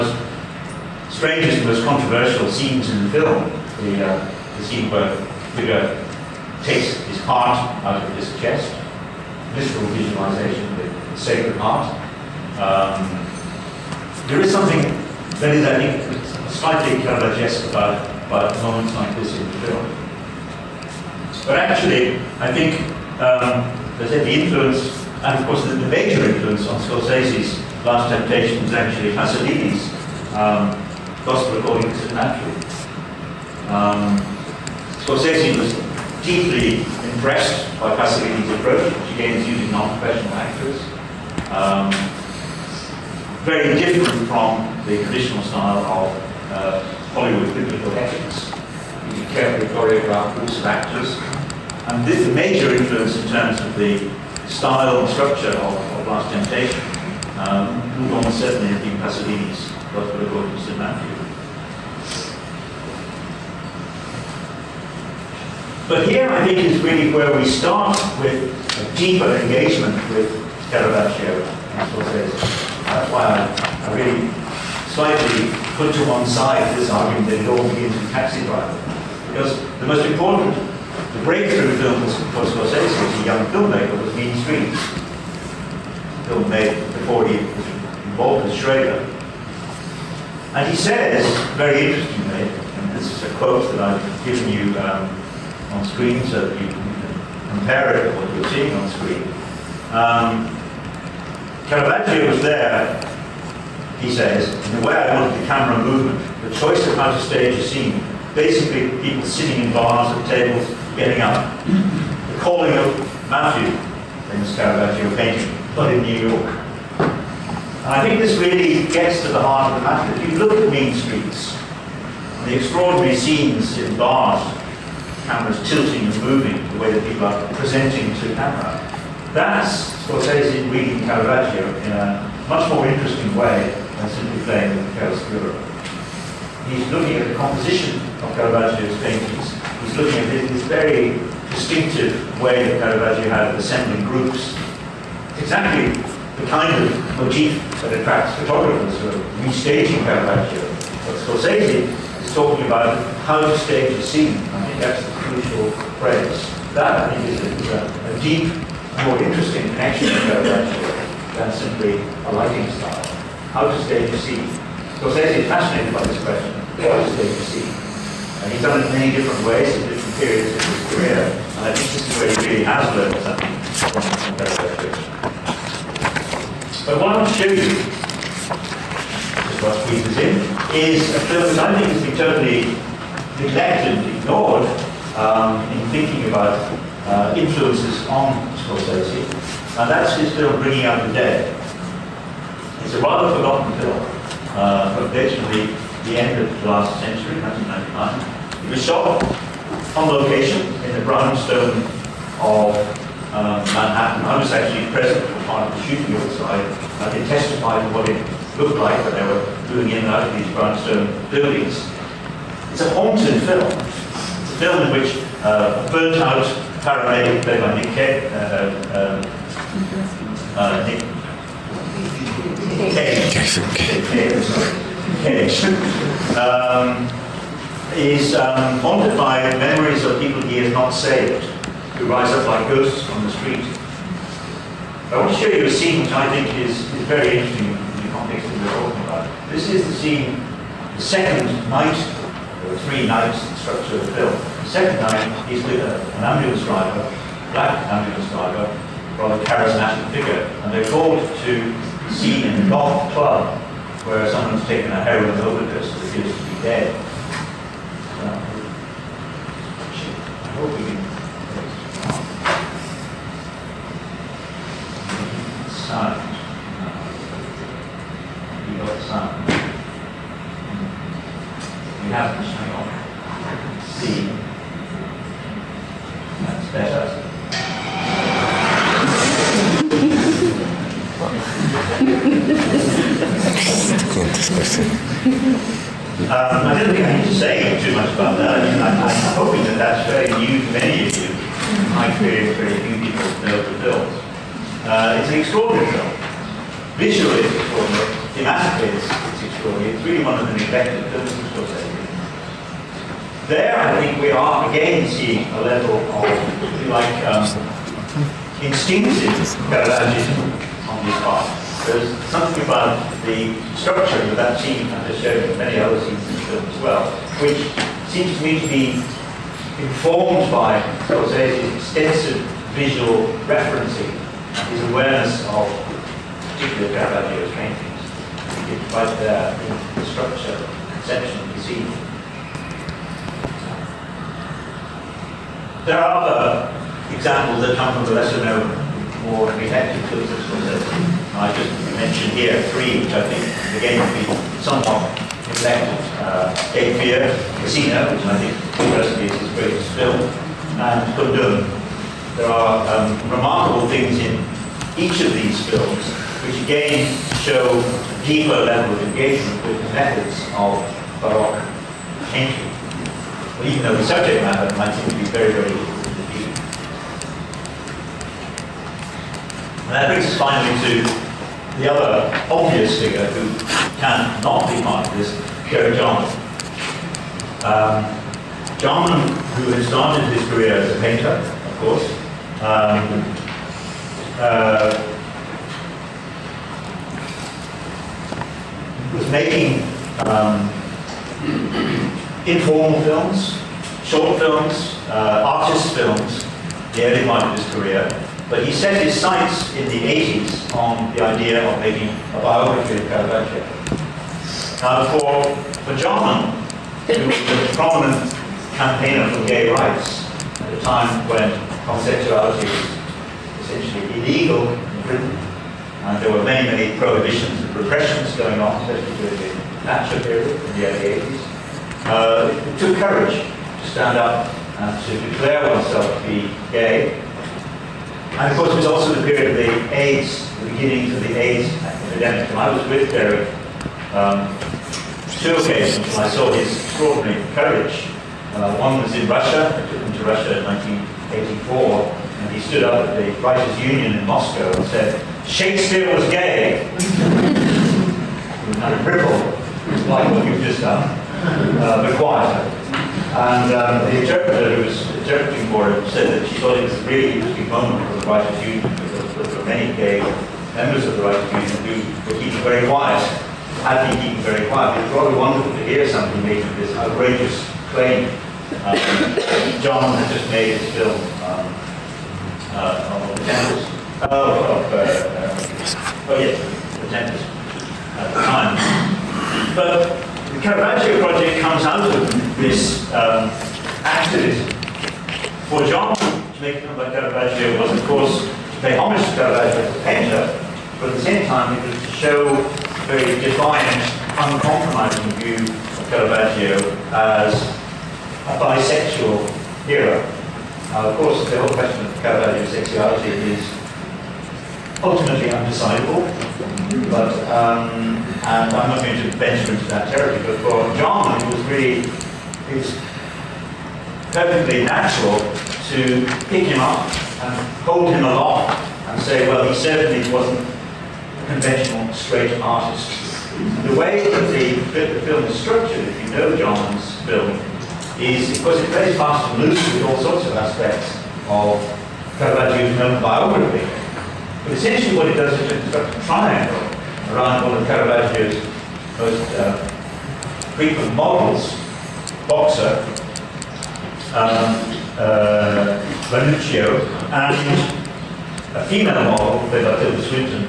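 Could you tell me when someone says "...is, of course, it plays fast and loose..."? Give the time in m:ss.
8:48.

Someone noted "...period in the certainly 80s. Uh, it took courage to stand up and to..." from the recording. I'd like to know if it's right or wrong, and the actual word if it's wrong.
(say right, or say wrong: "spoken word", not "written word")
wrong: "early", not "certainly".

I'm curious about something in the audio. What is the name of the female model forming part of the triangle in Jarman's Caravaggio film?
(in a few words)
Matilda.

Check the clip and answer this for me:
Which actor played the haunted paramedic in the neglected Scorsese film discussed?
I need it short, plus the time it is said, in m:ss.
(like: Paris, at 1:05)
Nick Cage, at 3:37.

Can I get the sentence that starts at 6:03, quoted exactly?
Well, even though the subject matter might seem to be very, very different.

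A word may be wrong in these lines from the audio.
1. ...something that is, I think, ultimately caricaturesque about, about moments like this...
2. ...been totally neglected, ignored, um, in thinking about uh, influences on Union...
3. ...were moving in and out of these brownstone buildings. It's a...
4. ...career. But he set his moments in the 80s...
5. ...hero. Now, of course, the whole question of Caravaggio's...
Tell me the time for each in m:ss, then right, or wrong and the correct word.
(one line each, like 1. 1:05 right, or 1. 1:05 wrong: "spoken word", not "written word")
1. 0:14 wrong: "slightly", not "ultimately"
2. 3:02 wrong: "Scorsese", not "Union"
3. 3:29 right
4. 6:37 wrong: "sights", not "moments"
5. 8:19 right.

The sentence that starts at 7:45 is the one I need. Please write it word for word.
It's rather wonderful to hear somebody making this outrageous claim um, Jarman had just made his film um, uh, on the Tempest.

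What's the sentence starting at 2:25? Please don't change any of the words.
Exactly the kind of motif that attracts photographers who are restaging Caravaggio.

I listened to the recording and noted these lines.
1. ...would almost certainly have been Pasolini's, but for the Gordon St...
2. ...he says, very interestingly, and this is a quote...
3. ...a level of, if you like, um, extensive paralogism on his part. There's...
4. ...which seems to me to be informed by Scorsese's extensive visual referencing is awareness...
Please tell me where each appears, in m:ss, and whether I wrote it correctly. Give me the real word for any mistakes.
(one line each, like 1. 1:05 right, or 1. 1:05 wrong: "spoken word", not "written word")
1. 0:58 right
2. 1:30 right
3. 5:05 wrong: "instinctive", not "extensive"
4. 5:17 right.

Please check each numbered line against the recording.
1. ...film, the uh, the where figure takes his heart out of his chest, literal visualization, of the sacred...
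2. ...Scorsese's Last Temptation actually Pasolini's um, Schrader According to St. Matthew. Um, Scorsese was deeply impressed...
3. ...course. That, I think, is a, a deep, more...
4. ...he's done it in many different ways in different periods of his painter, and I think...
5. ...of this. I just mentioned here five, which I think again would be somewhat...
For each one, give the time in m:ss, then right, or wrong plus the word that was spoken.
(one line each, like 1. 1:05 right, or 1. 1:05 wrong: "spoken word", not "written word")
1. 0:03 right
2. 0:26 wrong: "Gospel", not "Schrader"
3. 2:35 wrong: "phrase", not "course"
4. 2:48 wrong: "career", not "painter"
5. 5:40 wrong: "three", not "five".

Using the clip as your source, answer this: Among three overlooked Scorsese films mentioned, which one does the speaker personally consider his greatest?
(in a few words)
Casino.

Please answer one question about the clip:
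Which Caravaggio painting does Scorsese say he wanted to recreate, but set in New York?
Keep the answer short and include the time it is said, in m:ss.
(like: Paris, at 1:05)
The Calling of Matthew, at 1:51.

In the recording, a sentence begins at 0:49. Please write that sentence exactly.
You carefully choreographed groups of actors.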